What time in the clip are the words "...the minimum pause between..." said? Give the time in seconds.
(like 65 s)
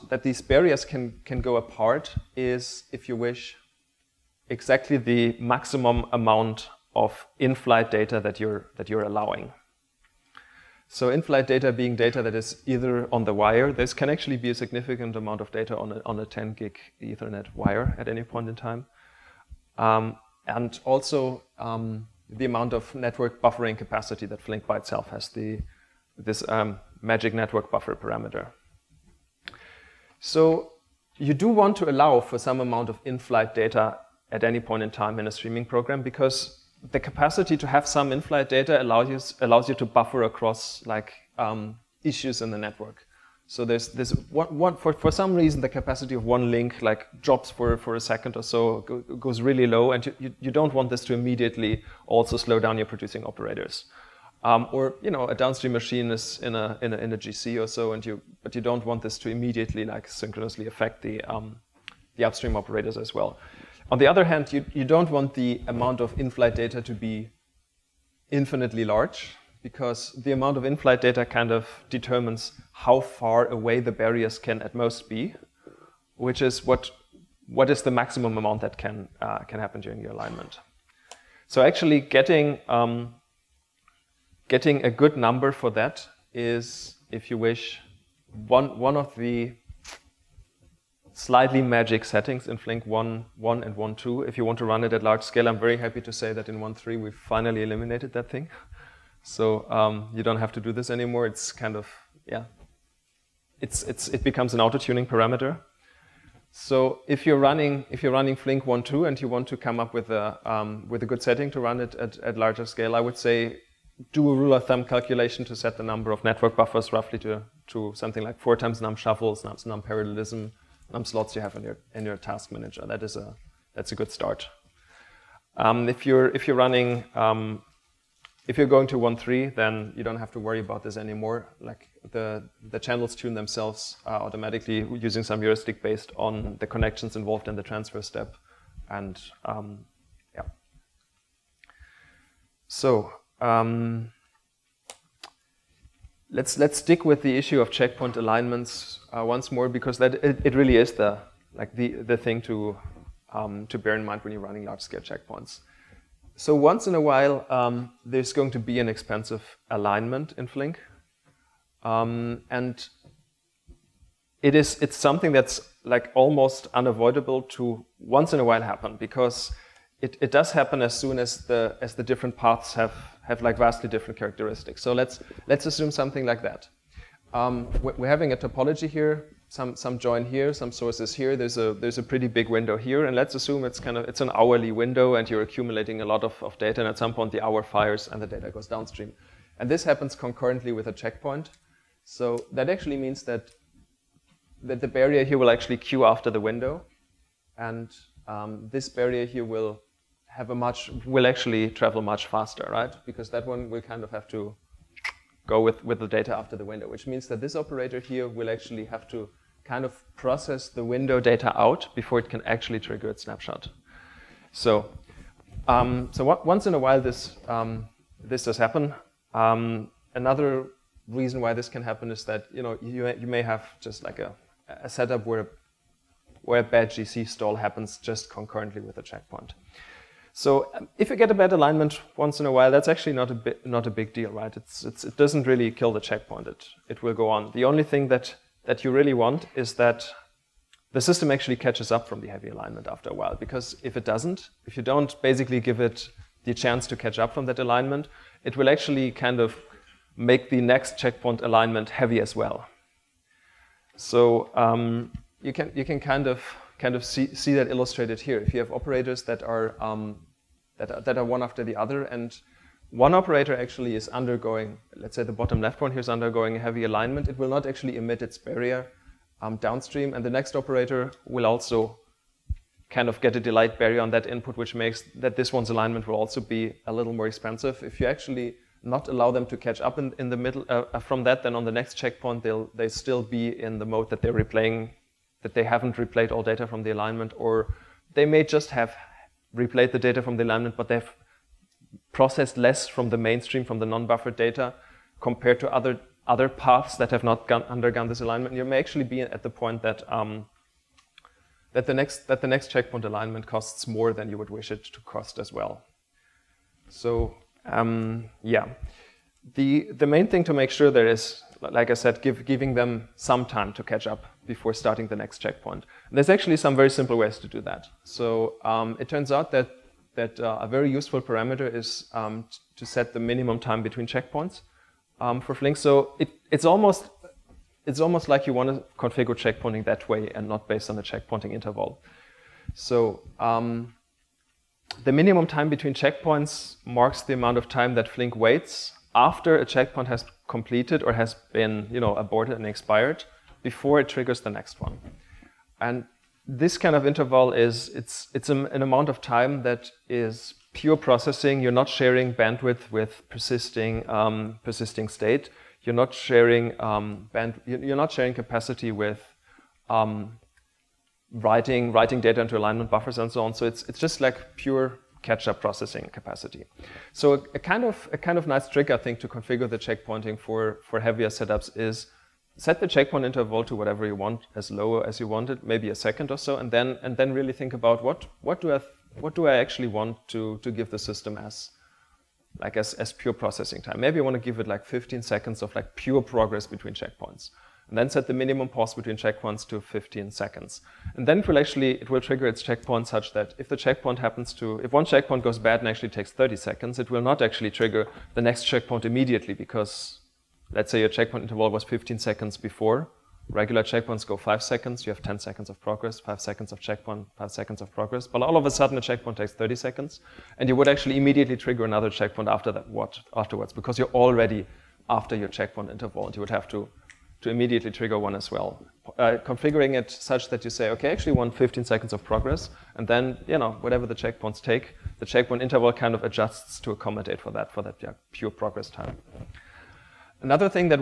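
388 s.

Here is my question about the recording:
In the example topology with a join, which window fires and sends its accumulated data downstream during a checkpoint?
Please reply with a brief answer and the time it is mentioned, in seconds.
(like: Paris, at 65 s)
hourly, at 184 s.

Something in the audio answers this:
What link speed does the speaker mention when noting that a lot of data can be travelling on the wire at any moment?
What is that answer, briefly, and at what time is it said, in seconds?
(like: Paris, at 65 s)
10 gig, at 16 s.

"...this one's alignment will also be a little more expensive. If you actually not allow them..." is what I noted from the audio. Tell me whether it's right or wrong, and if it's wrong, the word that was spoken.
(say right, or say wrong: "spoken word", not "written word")
right.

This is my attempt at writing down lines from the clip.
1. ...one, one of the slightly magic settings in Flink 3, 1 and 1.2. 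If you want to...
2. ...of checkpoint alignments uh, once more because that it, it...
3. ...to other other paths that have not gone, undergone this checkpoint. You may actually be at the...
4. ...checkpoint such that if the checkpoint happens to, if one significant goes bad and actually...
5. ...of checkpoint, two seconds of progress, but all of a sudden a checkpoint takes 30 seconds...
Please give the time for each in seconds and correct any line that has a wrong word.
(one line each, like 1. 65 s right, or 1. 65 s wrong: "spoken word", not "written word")
1. 88 s wrong: "1", not "3"
2. 147 s right
3. 295 s wrong: "alignment", not "checkpoint"
4. 392 s wrong: "checkpoint", not "significant"
5. 406 s wrong: "five", not "two".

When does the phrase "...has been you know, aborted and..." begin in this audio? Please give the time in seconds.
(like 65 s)
341 s.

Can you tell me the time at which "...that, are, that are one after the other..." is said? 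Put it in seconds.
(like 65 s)
260 s.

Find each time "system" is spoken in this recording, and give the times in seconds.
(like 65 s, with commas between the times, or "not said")
241 s, 380 s.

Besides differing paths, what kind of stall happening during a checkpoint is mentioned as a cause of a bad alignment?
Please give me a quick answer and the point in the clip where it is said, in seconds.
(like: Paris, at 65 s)
GC stall, at 226 s.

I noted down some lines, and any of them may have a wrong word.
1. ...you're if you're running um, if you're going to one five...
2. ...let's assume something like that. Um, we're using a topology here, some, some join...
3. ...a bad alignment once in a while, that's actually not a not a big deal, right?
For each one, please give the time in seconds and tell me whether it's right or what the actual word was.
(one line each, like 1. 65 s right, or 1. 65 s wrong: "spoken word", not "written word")
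1. 126 s wrong: "three", not "five"
2. 175 s wrong: "having", not "using"
3. 231 s right.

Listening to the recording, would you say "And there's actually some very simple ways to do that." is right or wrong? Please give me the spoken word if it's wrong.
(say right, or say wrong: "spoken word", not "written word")
right.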